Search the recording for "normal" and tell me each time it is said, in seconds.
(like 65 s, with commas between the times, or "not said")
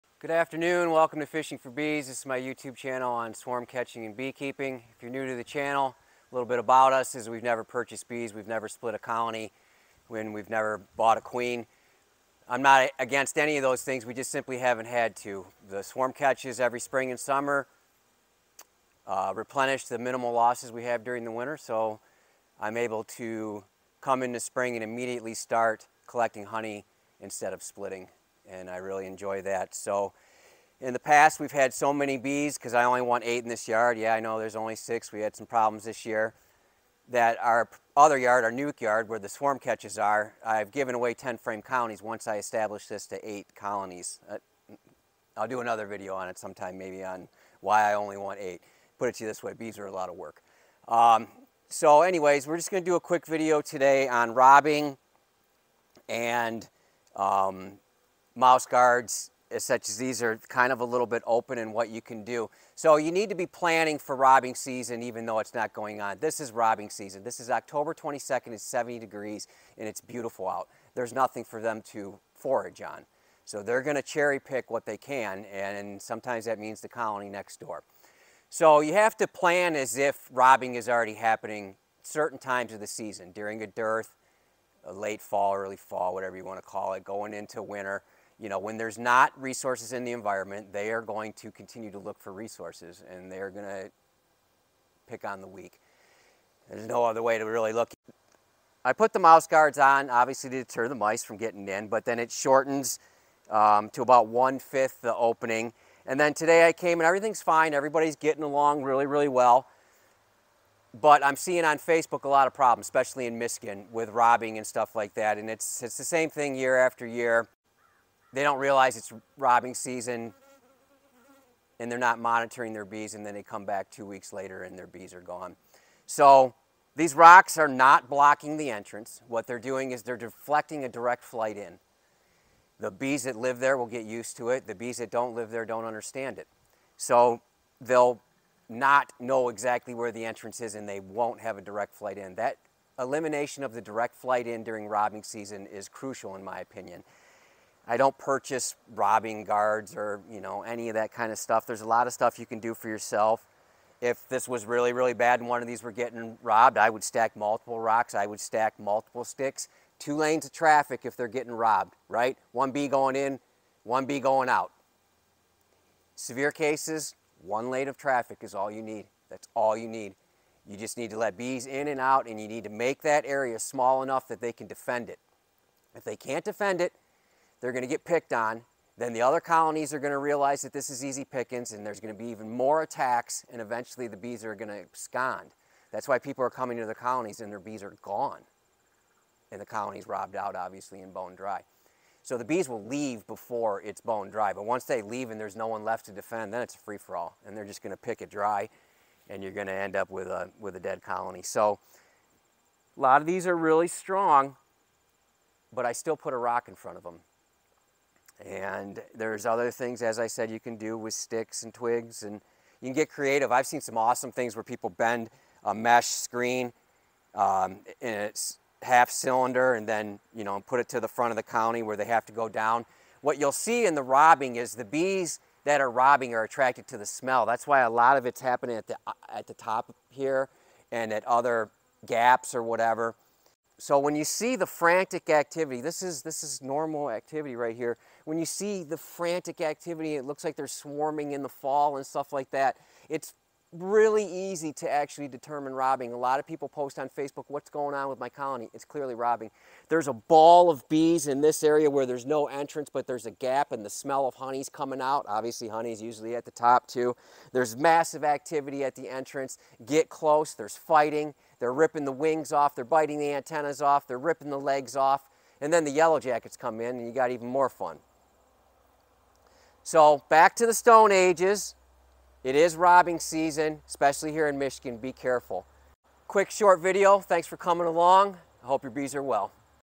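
236 s.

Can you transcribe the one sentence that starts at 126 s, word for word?
So these rocks are not blocking the entrance.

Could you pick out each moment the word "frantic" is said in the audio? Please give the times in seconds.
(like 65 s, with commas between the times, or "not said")
234 s, 238 s.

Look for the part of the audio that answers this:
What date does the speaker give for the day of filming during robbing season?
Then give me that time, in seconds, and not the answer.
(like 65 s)
67 s.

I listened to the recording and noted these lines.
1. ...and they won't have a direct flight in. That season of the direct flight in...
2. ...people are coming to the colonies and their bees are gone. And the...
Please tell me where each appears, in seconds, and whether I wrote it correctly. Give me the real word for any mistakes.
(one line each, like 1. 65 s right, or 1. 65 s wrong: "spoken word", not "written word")
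1. 140 s wrong: "elimination", not "season"
2. 186 s right.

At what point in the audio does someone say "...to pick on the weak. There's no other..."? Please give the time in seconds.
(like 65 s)
93 s.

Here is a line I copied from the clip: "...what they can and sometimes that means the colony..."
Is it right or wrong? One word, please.
right.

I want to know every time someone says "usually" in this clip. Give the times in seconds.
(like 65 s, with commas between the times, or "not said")
256 s.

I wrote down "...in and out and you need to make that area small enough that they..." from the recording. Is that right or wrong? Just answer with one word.
right.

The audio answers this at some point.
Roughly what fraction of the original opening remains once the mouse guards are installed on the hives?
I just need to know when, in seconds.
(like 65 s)
104 s.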